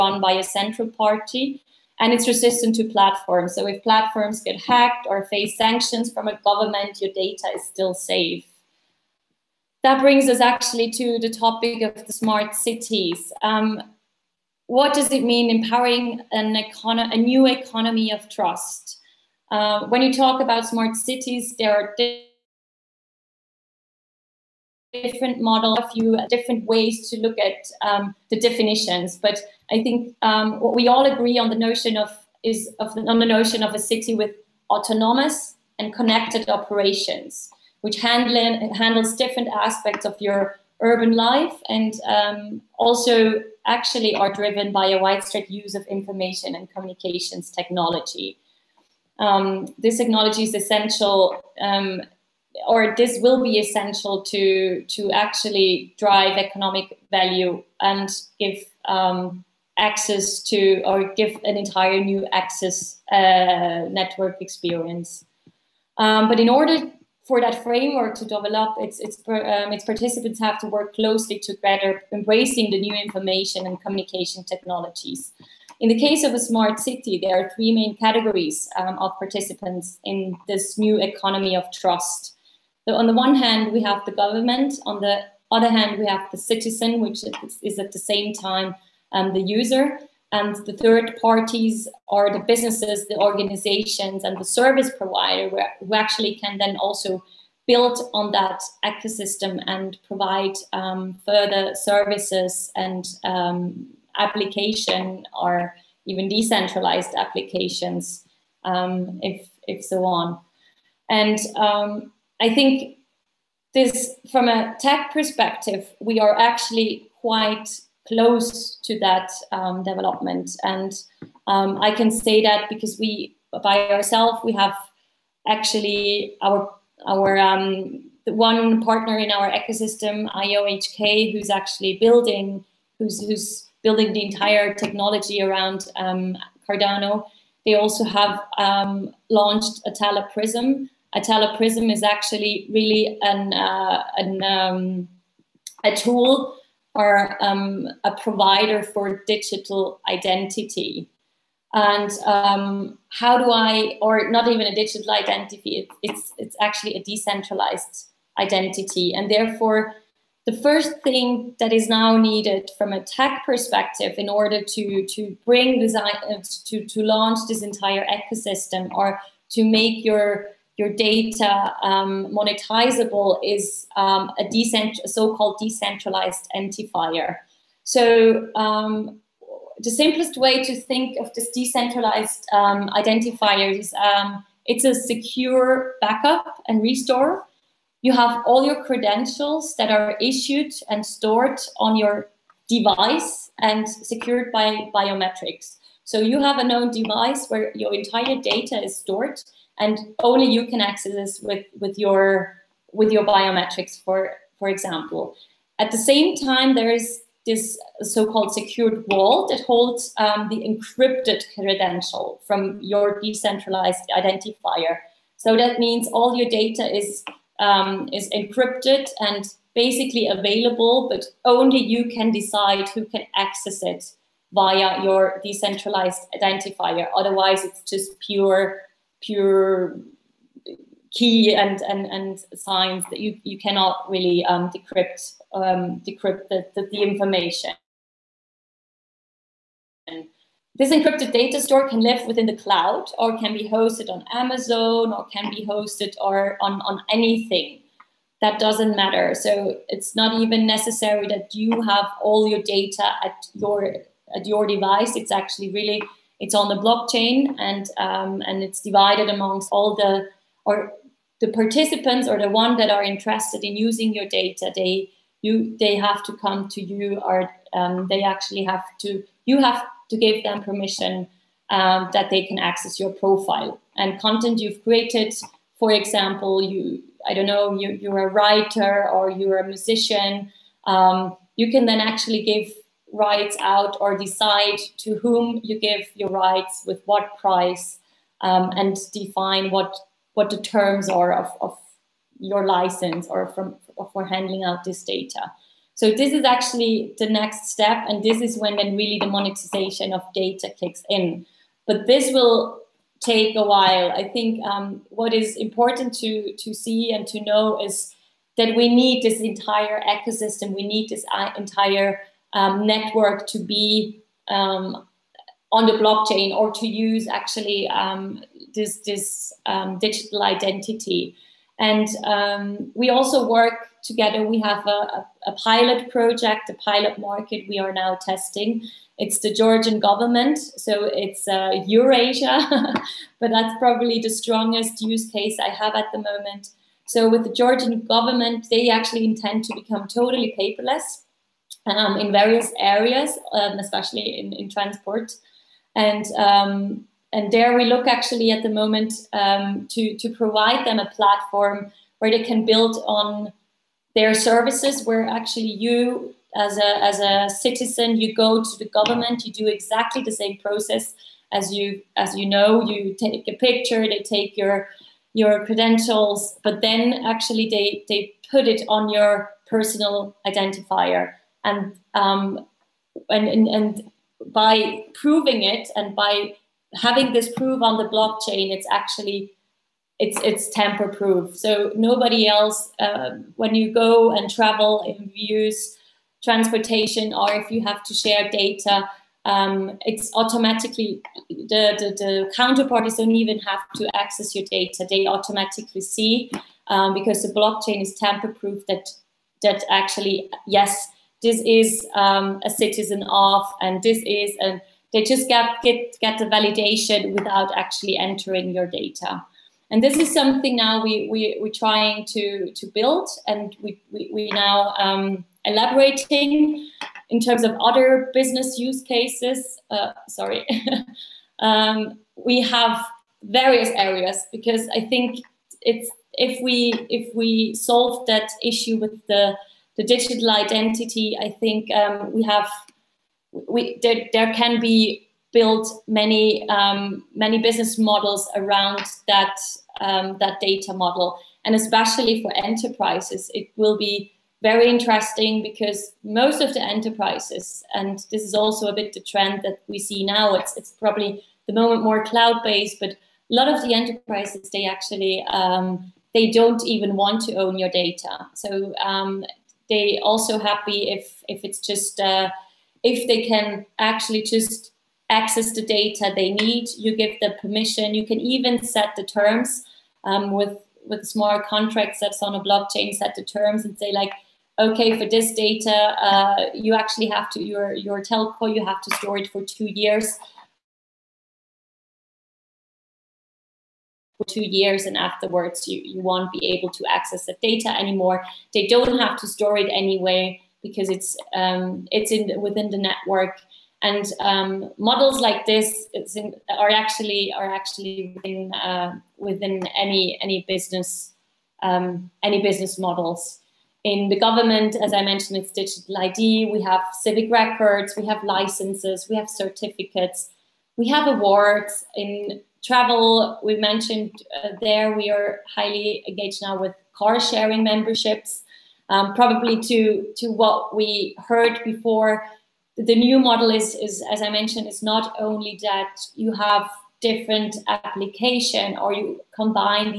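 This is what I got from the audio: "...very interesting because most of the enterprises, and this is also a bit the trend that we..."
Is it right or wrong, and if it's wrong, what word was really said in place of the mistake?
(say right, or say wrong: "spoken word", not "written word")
right.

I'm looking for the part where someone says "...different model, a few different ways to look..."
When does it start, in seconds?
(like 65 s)
25 s.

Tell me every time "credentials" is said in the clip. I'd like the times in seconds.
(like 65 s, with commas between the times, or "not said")
188 s, 211 s, 365 s.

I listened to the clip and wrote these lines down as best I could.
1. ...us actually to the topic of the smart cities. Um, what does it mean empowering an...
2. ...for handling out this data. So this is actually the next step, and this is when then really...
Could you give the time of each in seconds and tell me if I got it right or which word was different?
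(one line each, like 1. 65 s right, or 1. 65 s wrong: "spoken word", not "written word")
1. 10 s right
2. 294 s right.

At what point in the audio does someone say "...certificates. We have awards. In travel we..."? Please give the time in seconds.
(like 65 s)
509 s.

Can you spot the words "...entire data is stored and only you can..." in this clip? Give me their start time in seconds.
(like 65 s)
197 s.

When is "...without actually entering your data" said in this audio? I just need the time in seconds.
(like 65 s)
407 s.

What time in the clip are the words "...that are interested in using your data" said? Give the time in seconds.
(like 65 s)
262 s.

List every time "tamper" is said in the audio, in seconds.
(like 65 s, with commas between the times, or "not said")
380 s, 398 s.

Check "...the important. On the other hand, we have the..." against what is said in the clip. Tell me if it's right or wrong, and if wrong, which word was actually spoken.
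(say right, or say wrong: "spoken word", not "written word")
wrong: "government", not "important".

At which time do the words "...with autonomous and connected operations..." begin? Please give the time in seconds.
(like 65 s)
34 s.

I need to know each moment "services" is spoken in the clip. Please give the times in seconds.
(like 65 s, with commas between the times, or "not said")
94 s, 101 s, 354 s.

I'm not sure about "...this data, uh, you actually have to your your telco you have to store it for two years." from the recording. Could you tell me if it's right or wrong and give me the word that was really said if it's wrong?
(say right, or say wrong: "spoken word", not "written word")
right.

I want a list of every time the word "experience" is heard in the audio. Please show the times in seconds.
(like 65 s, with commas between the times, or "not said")
64 s.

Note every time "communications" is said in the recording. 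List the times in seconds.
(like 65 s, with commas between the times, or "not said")
46 s, 73 s.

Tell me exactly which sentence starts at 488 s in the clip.
They don't have to store it anyway because it's um, it's in within the network.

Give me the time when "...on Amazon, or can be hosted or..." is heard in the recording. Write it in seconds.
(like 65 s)
244 s.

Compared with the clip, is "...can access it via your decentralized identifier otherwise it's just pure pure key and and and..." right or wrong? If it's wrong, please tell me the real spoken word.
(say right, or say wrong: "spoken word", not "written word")
right.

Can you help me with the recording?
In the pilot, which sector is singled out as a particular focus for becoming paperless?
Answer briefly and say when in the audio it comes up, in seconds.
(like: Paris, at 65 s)
Transport, at 344 s.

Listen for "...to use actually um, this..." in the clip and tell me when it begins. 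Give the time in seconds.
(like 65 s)
316 s.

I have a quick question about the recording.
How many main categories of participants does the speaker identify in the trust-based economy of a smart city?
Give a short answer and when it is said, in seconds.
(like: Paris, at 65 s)
3, at 77 s.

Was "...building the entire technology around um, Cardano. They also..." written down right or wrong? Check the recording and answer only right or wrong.
right.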